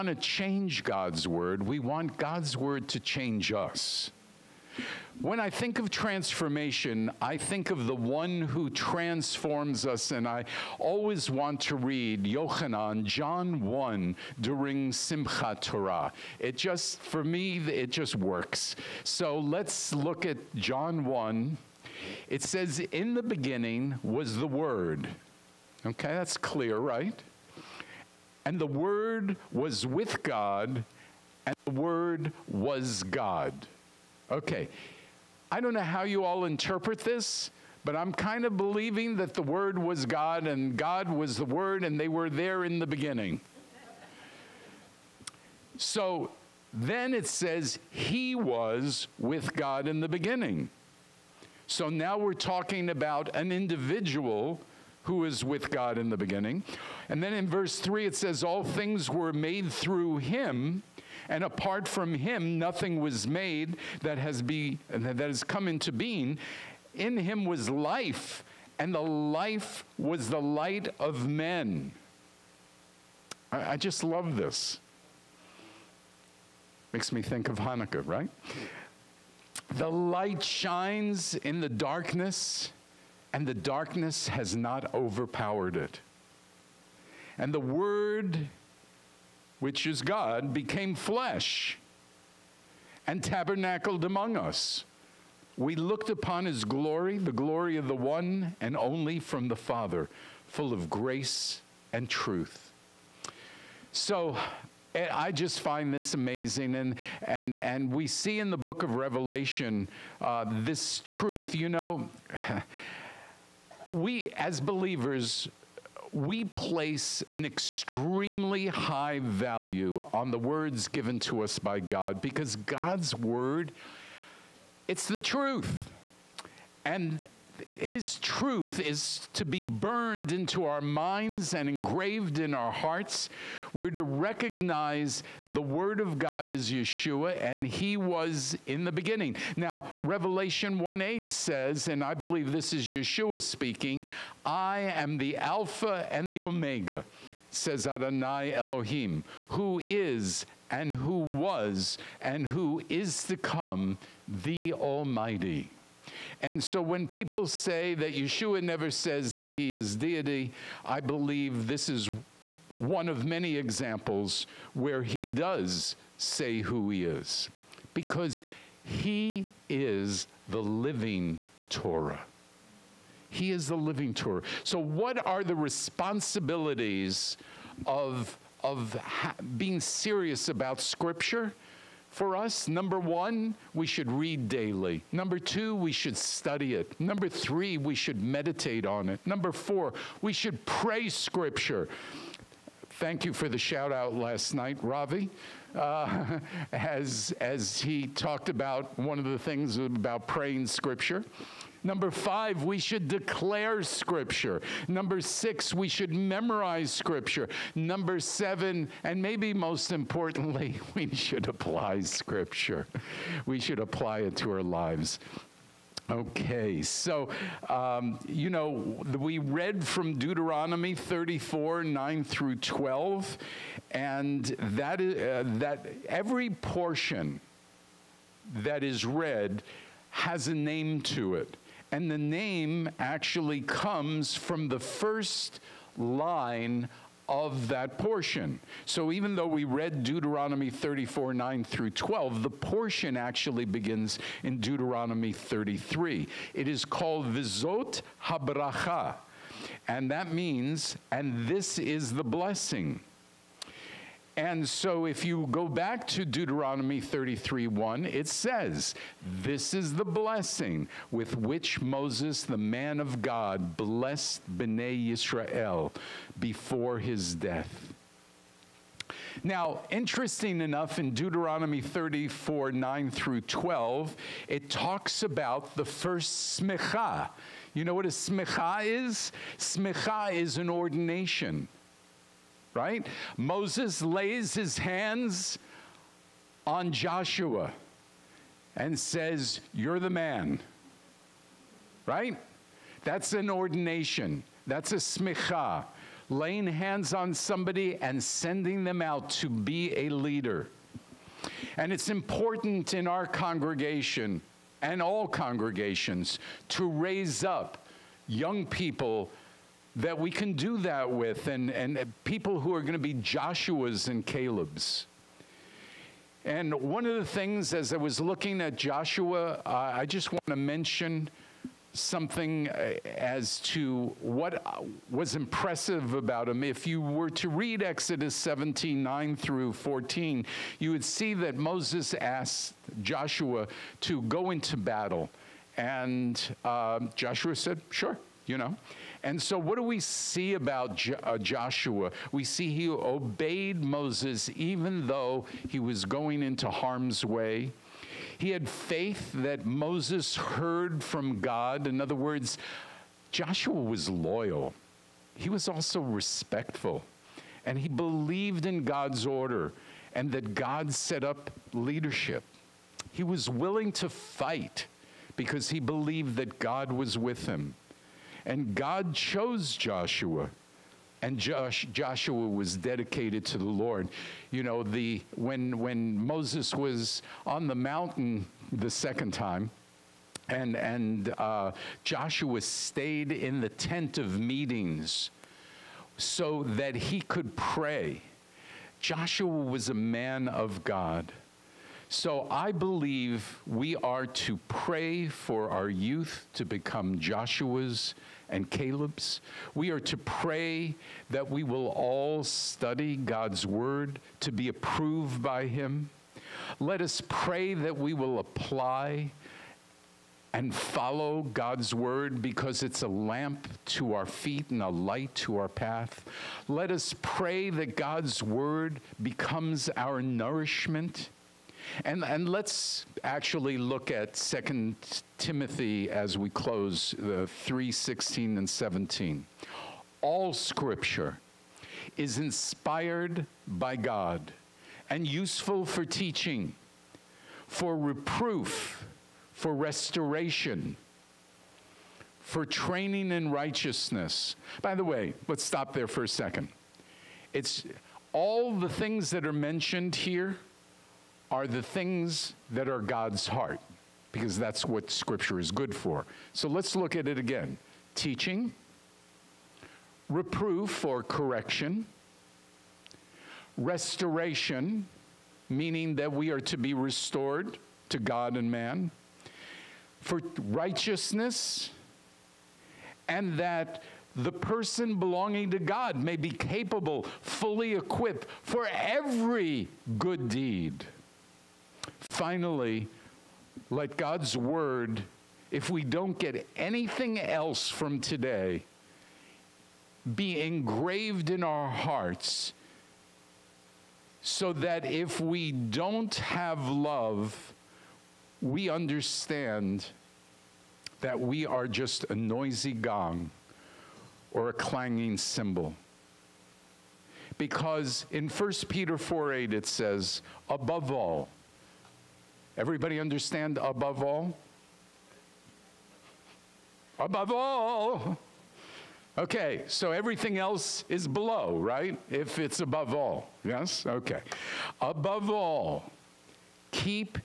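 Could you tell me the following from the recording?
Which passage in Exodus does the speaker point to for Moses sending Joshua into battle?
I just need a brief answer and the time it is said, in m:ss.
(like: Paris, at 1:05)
Exodus 17:9-14, at 5:27.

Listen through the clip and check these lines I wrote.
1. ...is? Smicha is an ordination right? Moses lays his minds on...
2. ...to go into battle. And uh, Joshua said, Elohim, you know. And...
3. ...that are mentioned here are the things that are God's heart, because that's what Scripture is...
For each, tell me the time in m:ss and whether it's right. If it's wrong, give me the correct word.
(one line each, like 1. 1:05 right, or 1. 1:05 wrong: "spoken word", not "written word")
1. 4:38 wrong: "hands", not "minds"
2. 5:34 wrong: "Sure", not "Elohim"
3. 7:29 right.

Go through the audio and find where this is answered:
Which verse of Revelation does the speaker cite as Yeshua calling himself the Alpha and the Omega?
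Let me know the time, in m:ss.
2:19.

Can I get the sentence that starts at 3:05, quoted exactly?
Number two, we should study it.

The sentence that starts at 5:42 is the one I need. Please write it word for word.
We see he obeyed Moses even though he was going into harm's way.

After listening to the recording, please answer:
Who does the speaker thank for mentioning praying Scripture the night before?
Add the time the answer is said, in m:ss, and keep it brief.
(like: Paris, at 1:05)
Ravi, at 3:14.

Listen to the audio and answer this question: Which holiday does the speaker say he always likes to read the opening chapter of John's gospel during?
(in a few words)
Simcha Torah.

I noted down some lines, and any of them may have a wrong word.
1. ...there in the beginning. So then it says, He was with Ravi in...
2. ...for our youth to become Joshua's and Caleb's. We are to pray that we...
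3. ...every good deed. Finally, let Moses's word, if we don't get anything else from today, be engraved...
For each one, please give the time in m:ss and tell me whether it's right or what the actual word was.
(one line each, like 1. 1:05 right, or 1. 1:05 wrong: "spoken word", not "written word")
1. 0:42 wrong: "God", not "Ravi"
2. 6:35 right
3. 7:58 wrong: "God", not "Moses".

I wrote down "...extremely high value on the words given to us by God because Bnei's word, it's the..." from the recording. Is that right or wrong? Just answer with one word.
wrong.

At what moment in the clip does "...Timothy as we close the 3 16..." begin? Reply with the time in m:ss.
7:05.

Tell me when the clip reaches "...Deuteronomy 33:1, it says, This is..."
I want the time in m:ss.
4:16.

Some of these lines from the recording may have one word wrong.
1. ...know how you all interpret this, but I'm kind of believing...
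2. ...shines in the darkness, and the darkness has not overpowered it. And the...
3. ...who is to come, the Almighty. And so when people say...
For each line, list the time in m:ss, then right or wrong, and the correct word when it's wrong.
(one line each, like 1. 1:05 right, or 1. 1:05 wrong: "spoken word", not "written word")
1. 0:35 right
2. 1:20 right
3. 2:32 right.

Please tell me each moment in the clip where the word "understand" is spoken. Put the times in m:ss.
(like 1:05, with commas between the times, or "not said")
8:18, 8:33.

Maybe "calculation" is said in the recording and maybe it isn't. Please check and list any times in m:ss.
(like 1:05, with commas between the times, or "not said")
not said.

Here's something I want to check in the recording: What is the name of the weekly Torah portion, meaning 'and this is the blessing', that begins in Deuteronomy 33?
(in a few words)
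Vizot Habracha.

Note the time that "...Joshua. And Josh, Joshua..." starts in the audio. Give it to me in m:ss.
6:09.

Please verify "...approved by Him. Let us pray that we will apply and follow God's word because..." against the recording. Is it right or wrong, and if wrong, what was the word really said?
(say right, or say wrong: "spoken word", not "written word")
right.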